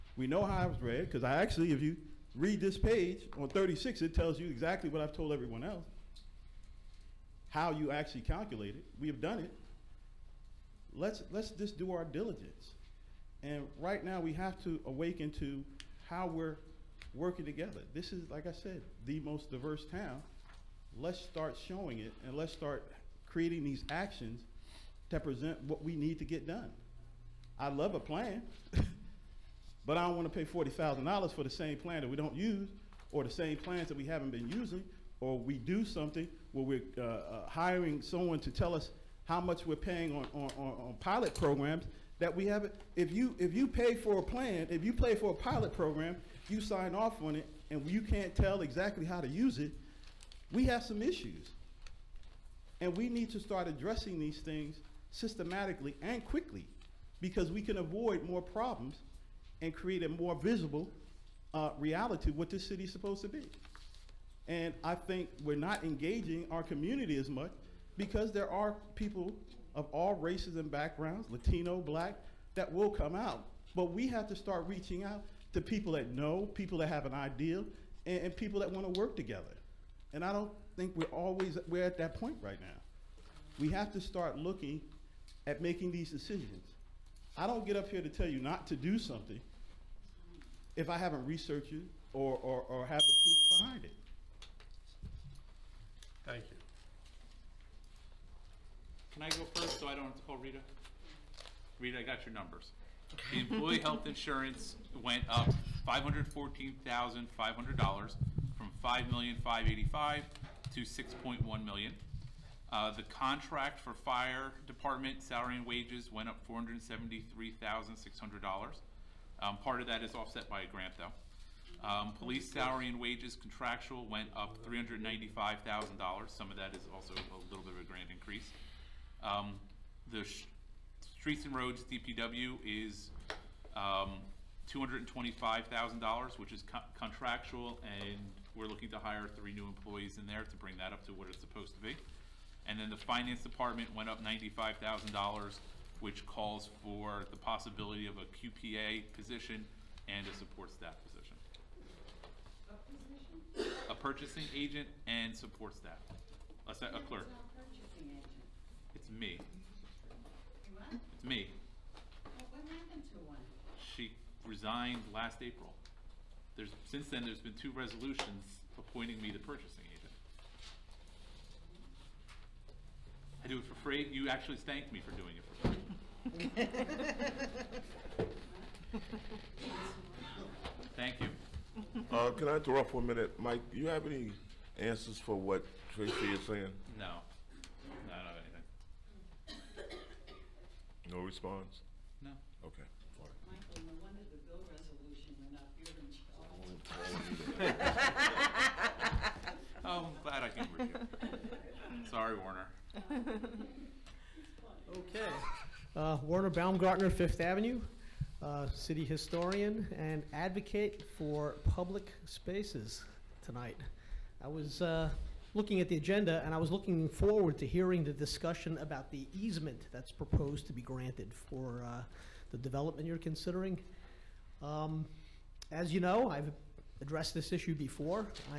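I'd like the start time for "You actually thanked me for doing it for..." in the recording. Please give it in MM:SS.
02:54.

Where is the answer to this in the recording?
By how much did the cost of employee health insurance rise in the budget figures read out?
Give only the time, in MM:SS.
01:45.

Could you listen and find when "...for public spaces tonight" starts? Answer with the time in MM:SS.
03:31.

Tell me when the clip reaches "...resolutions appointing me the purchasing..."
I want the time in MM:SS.
02:47.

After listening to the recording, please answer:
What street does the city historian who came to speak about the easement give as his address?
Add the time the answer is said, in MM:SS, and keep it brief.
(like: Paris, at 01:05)
Fifth Avenue, at 03:27.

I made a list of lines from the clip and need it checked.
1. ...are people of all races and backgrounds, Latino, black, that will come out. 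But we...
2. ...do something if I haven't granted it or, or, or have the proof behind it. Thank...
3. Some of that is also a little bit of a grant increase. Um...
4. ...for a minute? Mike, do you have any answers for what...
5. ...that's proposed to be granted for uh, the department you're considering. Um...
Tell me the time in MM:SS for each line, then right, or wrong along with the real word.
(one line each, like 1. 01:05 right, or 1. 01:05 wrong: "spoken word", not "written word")
1. 01:08 right
2. 01:28 wrong: "researched", not "granted"
3. 02:06 right
4. 03:02 right
5. 03:39 wrong: "development", not "department".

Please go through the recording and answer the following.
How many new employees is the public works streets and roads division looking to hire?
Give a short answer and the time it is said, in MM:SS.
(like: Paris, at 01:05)
3, at 02:19.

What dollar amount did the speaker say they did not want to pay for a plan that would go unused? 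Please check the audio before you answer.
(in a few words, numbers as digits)
$40,000.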